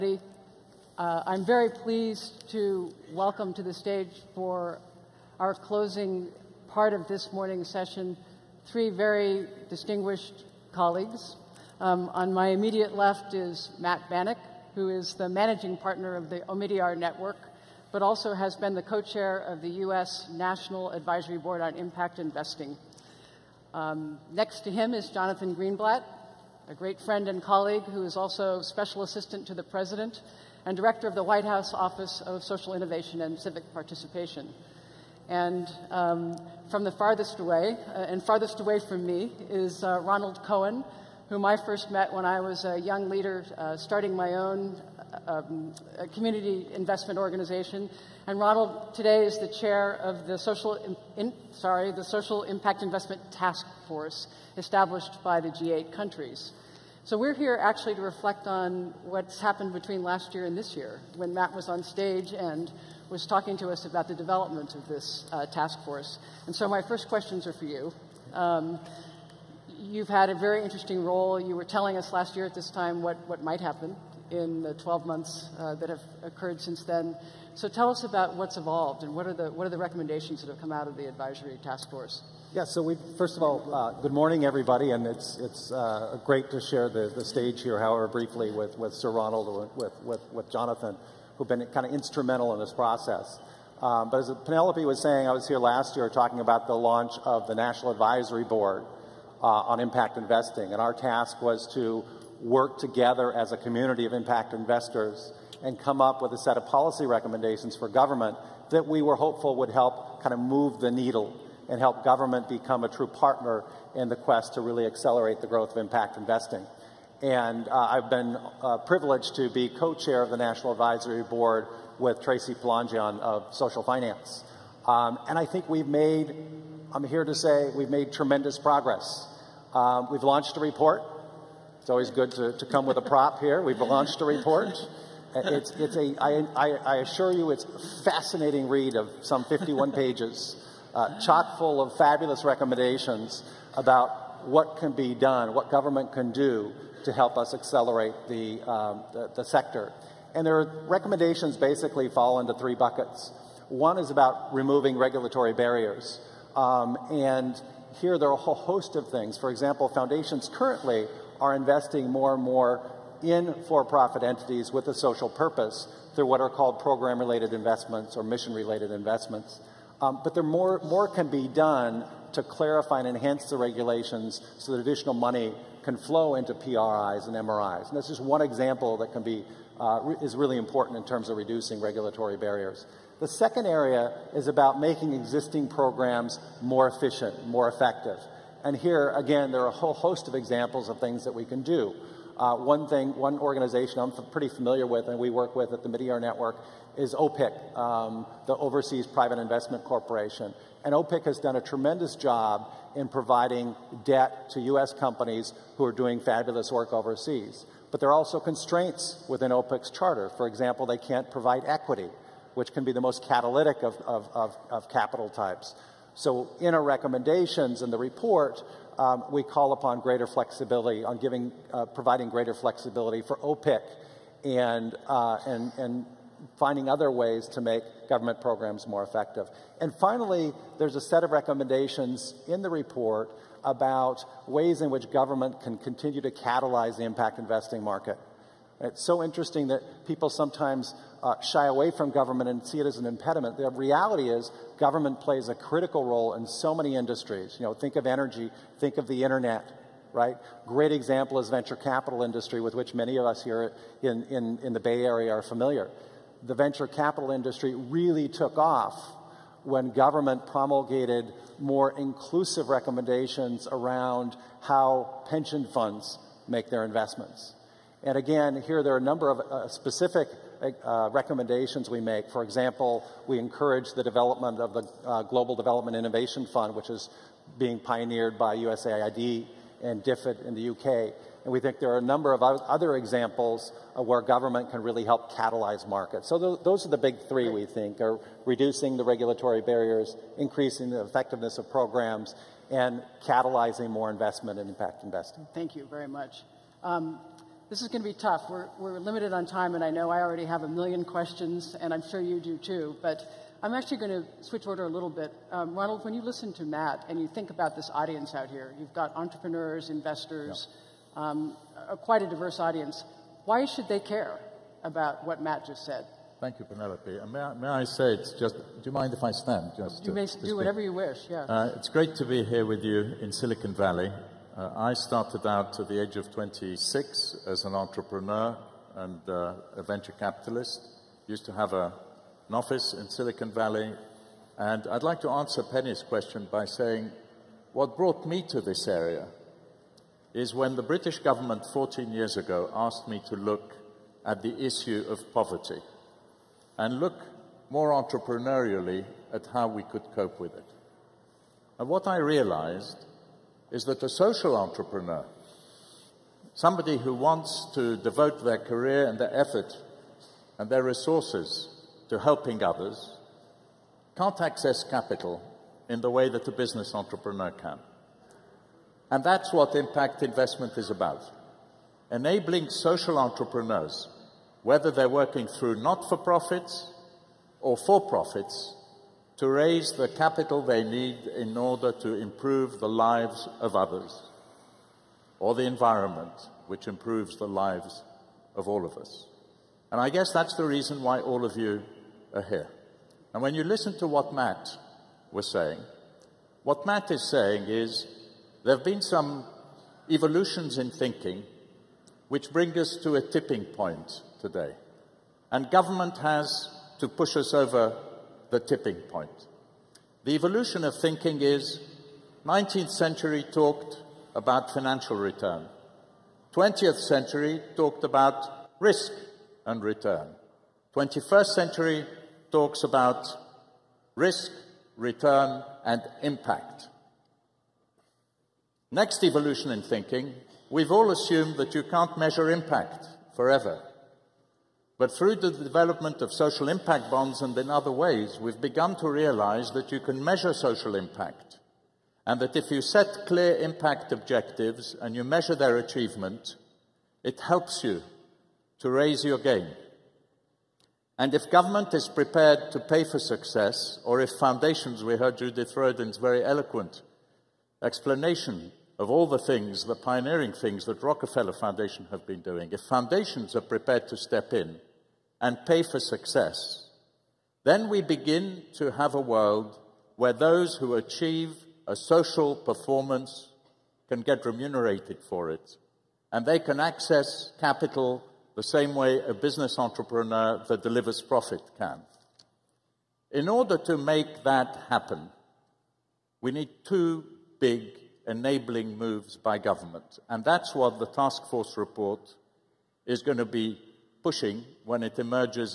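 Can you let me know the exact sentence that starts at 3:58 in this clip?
It's so interesting that people sometimes uh, shy away from government and see it as an impediment.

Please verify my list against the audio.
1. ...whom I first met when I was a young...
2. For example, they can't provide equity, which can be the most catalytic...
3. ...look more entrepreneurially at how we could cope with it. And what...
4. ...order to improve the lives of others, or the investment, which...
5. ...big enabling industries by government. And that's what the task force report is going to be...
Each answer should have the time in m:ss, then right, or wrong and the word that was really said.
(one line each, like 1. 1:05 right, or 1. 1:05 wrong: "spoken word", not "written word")
1. 0:41 right
2. 3:30 right
3. 5:47 right
4. 6:21 wrong: "environment", not "investment"
5. 8:07 wrong: "moves", not "industries".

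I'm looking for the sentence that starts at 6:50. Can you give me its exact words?
The evolution of thinking is 19th century talked about financial return.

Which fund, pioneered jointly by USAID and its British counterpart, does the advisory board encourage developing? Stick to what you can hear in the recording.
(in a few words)
Global Development Innovation Fund.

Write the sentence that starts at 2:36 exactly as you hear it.
Um, and here there are a whole host of things.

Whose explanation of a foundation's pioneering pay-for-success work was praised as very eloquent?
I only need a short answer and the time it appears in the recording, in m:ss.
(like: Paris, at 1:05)
Judith Rodin, at 7:35.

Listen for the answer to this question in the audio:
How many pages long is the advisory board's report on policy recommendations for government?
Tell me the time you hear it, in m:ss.
2:19.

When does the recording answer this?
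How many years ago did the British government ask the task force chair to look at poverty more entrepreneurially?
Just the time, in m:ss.
5:41.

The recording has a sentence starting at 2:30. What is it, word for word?
And their recommendations basically fall into three buckets.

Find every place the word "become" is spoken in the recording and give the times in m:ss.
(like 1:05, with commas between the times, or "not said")
1:52.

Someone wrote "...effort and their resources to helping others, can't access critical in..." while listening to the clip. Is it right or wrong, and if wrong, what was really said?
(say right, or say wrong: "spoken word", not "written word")
wrong: "capital", not "critical".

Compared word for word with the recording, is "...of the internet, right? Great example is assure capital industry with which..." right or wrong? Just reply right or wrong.
wrong.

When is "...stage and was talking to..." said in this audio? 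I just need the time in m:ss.
1:01.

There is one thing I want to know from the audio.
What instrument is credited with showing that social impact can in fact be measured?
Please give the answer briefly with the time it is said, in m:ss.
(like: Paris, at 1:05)
social impact bonds, at 7:16.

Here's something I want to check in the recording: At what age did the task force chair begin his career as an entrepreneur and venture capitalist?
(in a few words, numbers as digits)
26.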